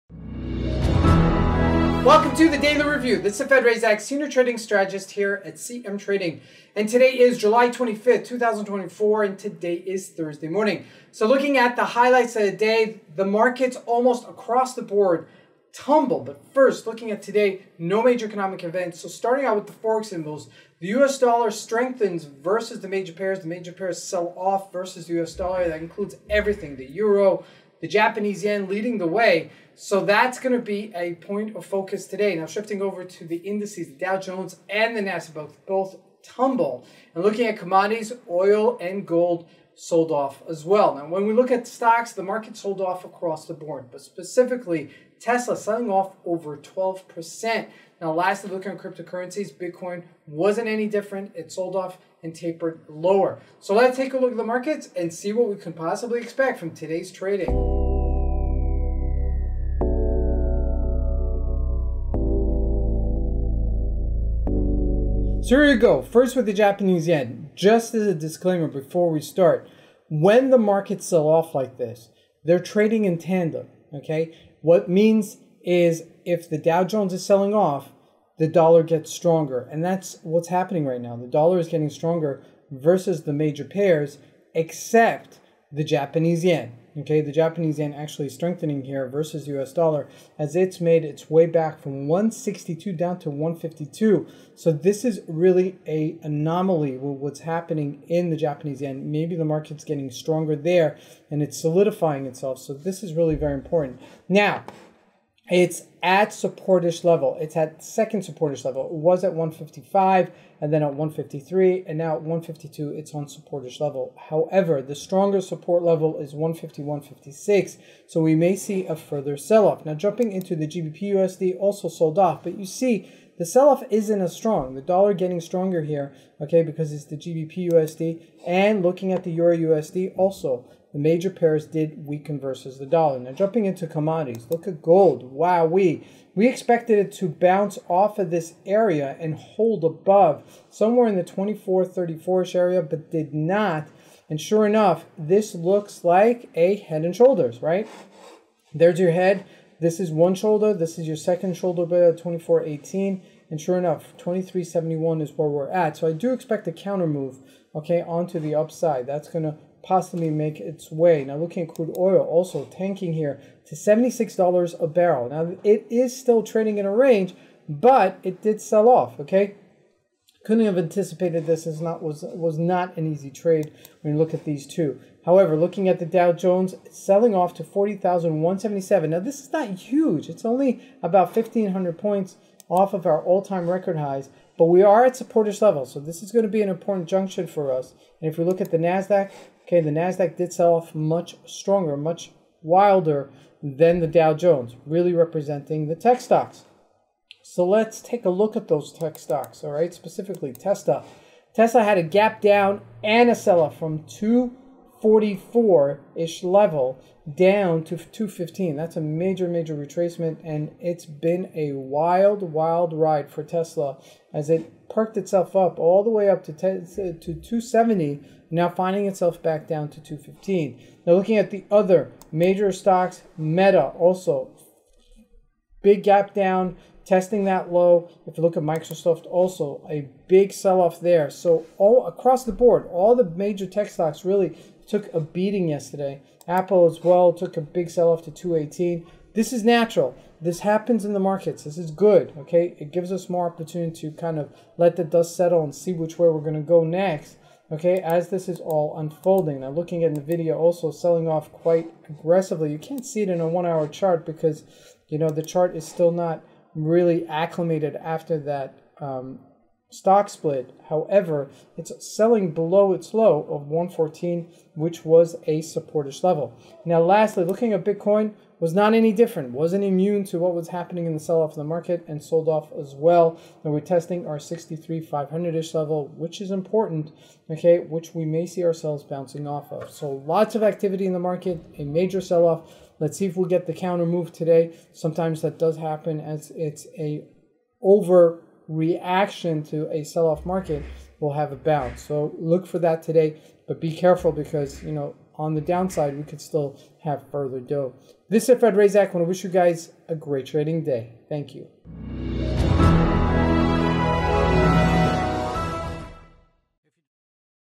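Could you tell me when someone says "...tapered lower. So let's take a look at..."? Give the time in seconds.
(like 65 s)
52 s.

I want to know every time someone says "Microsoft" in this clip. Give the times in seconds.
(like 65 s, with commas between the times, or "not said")
228 s.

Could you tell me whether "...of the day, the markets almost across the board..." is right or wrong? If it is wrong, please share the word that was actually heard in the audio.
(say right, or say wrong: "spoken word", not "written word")
right.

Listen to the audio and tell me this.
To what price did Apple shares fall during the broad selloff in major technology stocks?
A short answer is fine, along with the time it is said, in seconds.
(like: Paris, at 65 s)
218, at 238 s.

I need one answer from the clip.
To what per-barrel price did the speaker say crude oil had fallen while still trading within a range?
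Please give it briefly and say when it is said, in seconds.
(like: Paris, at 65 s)
$76, at 163 s.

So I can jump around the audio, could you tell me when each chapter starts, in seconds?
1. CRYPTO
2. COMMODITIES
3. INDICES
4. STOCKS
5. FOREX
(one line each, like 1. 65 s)
1. 267 s
2. 135 s
3. 174 s
4. 201 s
5. 65 s.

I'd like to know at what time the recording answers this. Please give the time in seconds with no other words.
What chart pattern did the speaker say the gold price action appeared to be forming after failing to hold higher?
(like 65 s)
146 s.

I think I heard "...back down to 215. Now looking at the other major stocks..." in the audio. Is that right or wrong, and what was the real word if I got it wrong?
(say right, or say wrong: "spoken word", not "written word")
right.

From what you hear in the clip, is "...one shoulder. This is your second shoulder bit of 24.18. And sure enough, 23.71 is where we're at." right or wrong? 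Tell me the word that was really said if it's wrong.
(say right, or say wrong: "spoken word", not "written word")
right.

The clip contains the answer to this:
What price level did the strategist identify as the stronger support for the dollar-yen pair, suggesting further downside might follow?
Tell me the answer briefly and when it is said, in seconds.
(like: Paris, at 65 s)
151.56, at 116 s.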